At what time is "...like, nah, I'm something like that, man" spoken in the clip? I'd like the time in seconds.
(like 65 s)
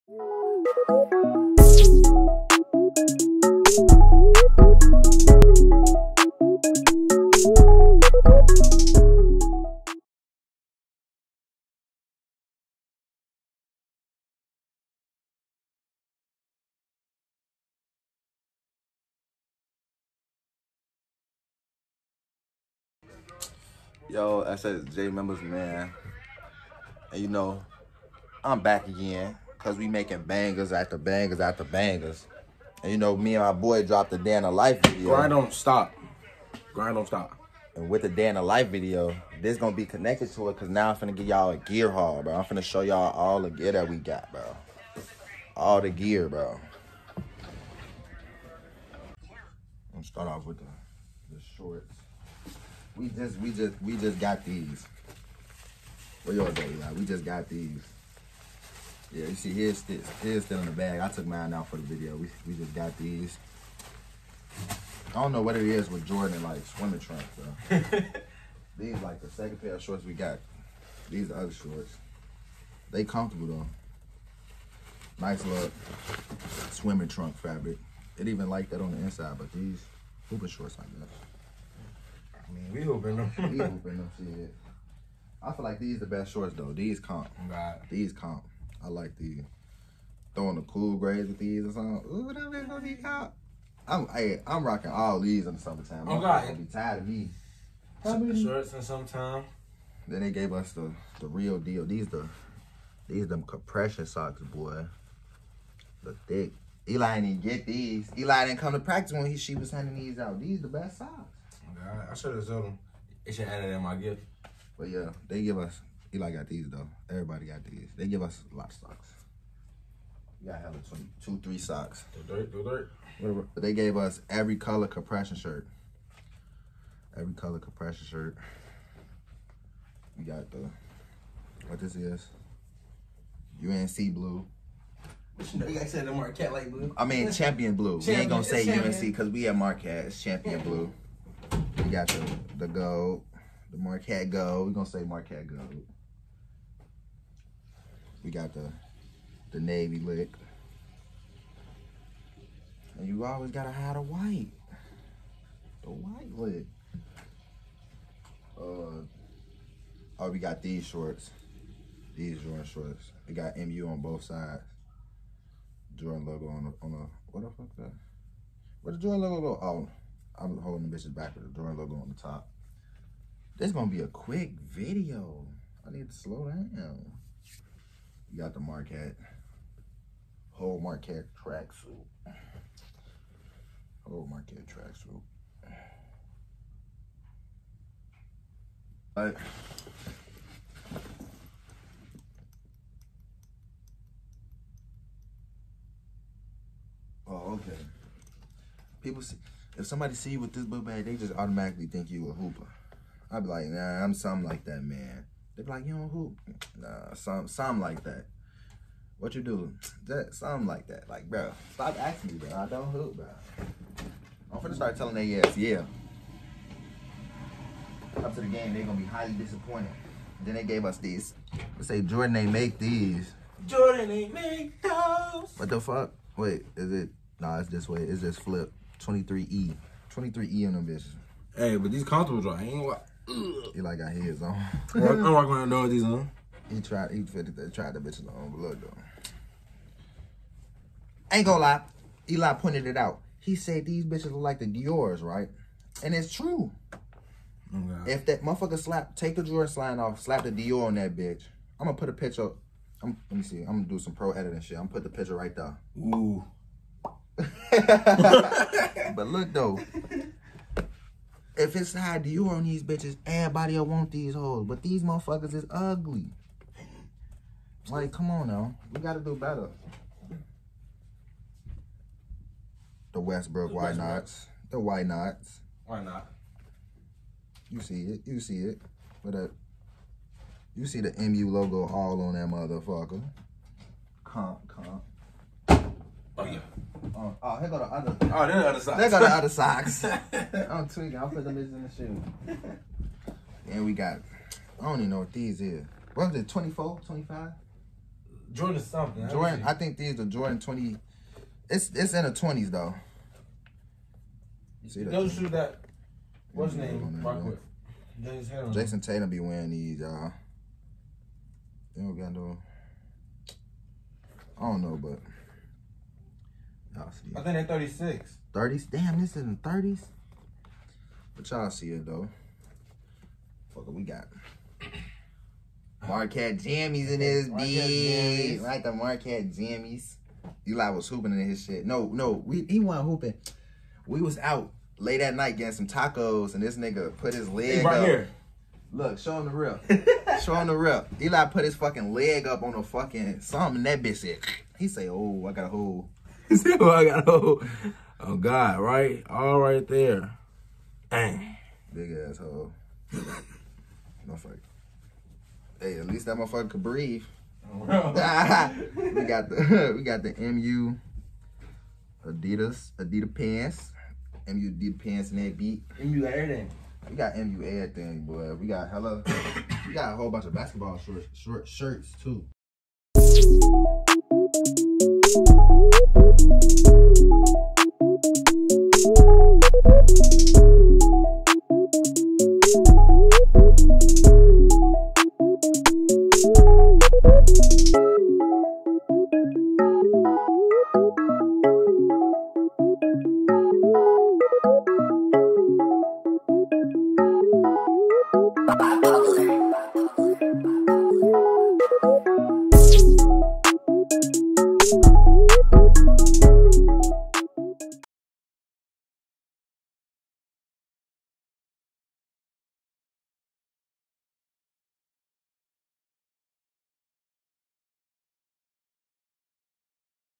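203 s.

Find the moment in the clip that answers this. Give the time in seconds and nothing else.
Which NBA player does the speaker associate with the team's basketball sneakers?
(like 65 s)
308 s.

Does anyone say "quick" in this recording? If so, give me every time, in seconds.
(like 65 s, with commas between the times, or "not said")
174 s.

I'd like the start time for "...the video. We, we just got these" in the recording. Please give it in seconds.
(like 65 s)
61 s.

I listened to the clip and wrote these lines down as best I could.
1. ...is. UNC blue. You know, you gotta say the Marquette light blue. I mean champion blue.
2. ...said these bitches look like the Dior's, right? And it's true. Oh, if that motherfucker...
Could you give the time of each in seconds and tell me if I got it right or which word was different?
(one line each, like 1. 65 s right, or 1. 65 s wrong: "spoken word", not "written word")
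1. 131 s right
2. 243 s right.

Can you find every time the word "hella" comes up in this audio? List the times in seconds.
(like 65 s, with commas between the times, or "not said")
120 s, 368 s.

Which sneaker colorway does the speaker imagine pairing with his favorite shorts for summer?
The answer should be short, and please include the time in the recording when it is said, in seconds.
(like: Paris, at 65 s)
cool grays, at 90 s.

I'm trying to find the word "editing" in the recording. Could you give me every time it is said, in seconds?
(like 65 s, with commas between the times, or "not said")
254 s.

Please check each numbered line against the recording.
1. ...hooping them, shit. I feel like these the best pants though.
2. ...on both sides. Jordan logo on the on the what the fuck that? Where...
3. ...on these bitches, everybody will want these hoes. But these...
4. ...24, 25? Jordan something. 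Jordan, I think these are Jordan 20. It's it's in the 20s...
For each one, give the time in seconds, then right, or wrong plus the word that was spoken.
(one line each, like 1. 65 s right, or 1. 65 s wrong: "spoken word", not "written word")
1. 83 s wrong: "shorts", not "pants"
2. 163 s right
3. 262 s right
4. 296 s right.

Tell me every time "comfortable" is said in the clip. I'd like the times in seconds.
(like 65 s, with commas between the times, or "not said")
73 s, 232 s.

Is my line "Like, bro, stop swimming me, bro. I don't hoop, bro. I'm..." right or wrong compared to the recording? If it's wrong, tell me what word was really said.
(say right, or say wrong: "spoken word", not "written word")
wrong: "asking", not "swimming".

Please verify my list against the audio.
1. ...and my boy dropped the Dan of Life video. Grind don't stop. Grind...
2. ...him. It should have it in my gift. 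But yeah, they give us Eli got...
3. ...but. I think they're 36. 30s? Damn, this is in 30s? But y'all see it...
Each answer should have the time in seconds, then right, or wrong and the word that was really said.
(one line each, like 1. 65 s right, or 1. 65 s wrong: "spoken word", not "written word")
1. 33 s right
2. 112 s right
3. 315 s right.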